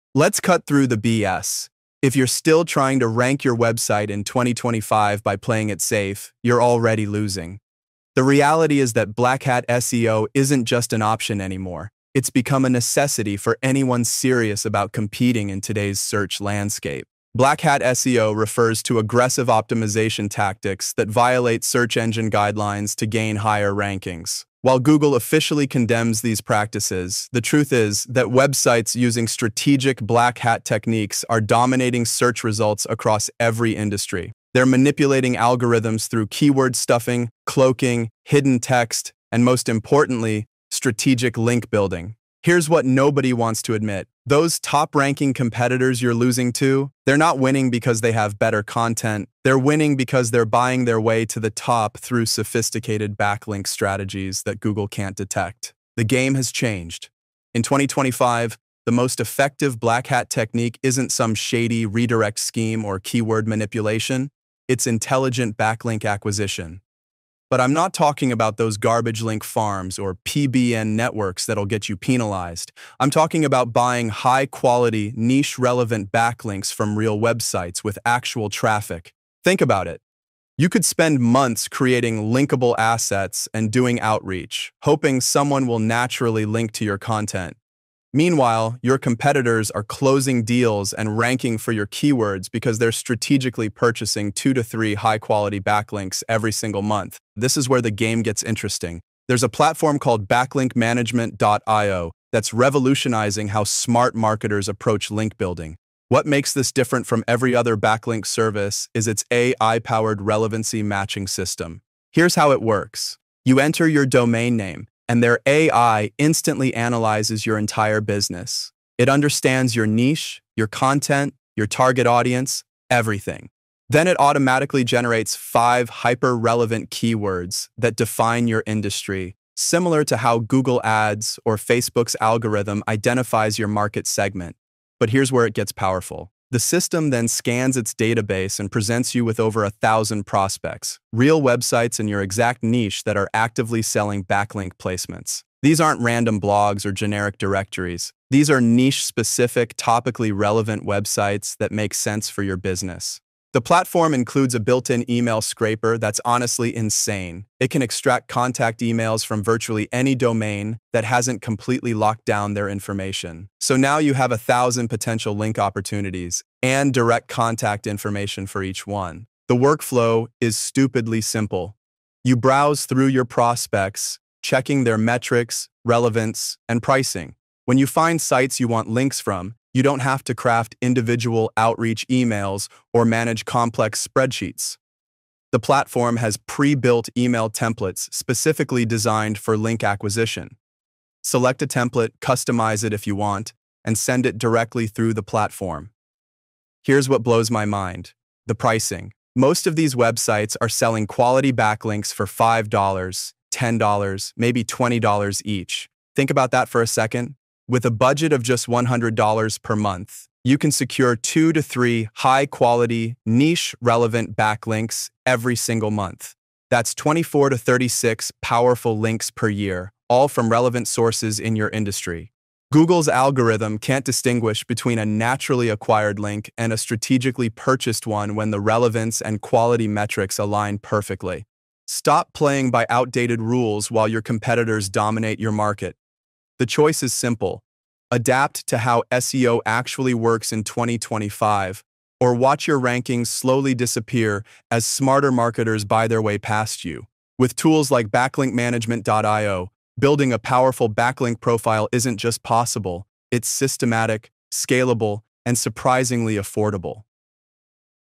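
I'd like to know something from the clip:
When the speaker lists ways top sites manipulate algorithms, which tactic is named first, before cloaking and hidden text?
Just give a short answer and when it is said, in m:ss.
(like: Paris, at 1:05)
keyword stuffing, at 0:36.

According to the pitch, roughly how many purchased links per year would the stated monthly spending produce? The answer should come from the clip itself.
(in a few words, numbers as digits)
24 to 36.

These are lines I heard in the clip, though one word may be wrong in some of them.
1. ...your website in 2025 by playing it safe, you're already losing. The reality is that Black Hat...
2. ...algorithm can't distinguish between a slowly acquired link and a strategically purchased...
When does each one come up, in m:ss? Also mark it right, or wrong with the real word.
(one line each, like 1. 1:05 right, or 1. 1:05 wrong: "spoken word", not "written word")
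1. 0:03 right
2. 3:43 wrong: "naturally", not "slowly".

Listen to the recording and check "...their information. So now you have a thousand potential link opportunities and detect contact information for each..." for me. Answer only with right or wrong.
wrong.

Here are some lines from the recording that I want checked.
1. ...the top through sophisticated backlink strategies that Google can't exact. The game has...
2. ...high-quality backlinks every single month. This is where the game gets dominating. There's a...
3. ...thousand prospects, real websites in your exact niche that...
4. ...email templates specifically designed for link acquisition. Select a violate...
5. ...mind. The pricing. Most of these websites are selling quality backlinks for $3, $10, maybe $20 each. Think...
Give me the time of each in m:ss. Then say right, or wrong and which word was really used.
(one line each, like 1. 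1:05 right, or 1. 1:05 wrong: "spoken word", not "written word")
1. 0:51 wrong: "detect", not "exact"
2. 1:34 wrong: "interesting", not "dominating"
3. 2:19 right
4. 3:07 wrong: "template", not "violate"
5. 3:17 wrong: "5", not "3".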